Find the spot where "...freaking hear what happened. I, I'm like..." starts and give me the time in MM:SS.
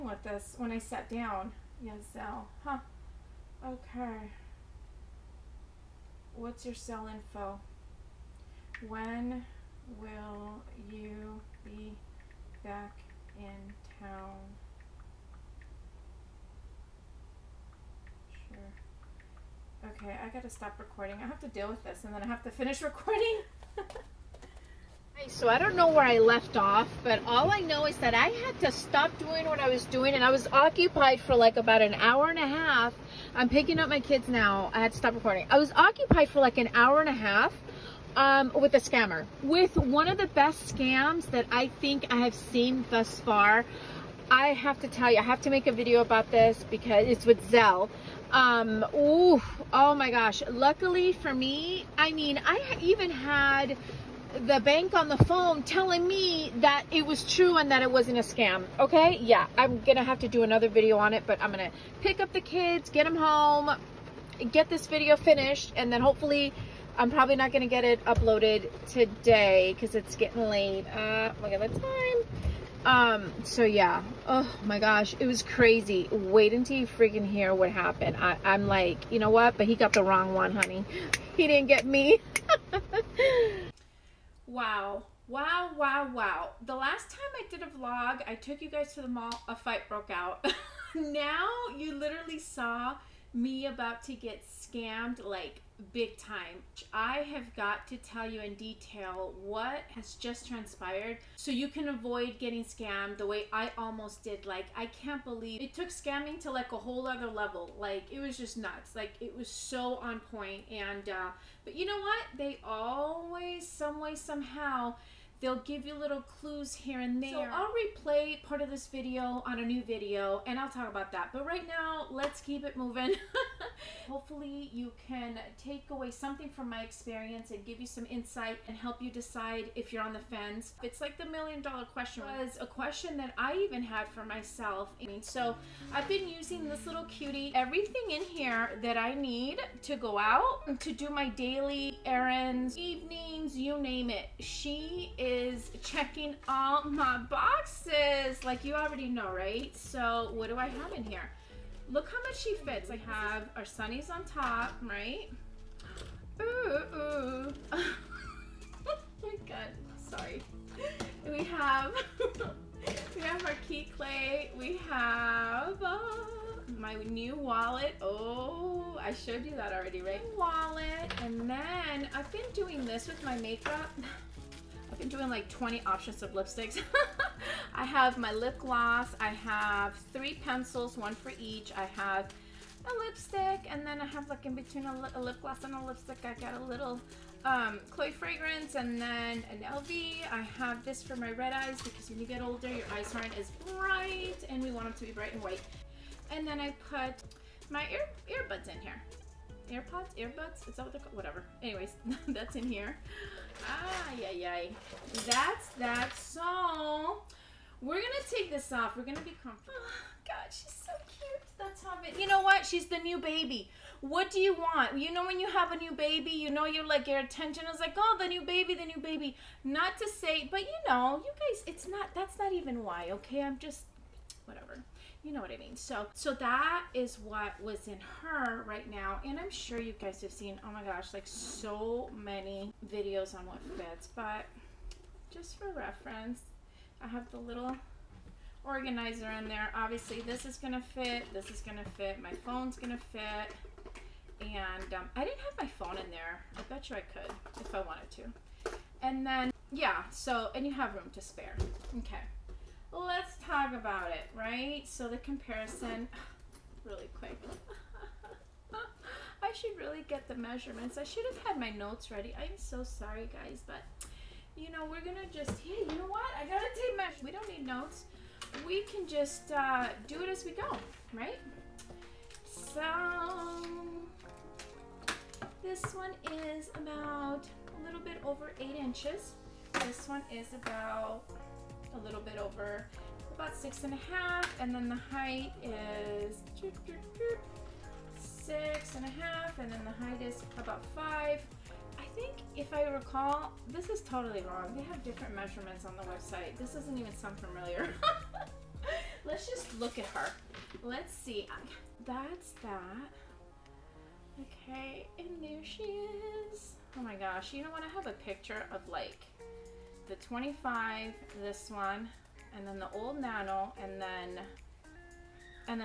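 01:16.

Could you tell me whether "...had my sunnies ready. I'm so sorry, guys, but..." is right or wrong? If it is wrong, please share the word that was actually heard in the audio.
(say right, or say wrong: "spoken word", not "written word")
wrong: "notes", not "sunnies".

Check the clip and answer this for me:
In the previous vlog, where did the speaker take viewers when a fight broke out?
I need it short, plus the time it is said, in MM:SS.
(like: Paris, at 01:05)
the mall, at 01:29.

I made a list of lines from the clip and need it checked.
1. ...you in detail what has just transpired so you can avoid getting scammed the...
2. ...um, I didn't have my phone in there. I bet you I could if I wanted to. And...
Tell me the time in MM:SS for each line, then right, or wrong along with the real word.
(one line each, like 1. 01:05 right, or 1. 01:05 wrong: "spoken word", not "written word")
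1. 01:38 right
2. 04:04 right.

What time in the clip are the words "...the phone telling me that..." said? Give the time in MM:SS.
00:55.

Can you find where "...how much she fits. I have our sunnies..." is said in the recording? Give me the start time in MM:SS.
02:32.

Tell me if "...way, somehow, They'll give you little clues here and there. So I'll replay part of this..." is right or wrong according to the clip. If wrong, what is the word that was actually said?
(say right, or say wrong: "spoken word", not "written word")
right.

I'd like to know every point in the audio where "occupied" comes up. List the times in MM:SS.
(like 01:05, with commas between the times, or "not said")
00:30, 00:35.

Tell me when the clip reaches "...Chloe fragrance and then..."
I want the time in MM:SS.
03:07.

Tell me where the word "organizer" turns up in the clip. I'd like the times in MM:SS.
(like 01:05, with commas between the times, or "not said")
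03:58.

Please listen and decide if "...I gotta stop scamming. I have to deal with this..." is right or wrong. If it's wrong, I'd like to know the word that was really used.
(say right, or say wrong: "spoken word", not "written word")
wrong: "recording", not "scamming".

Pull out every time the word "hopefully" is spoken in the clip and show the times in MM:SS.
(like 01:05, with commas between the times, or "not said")
01:06, 02:04.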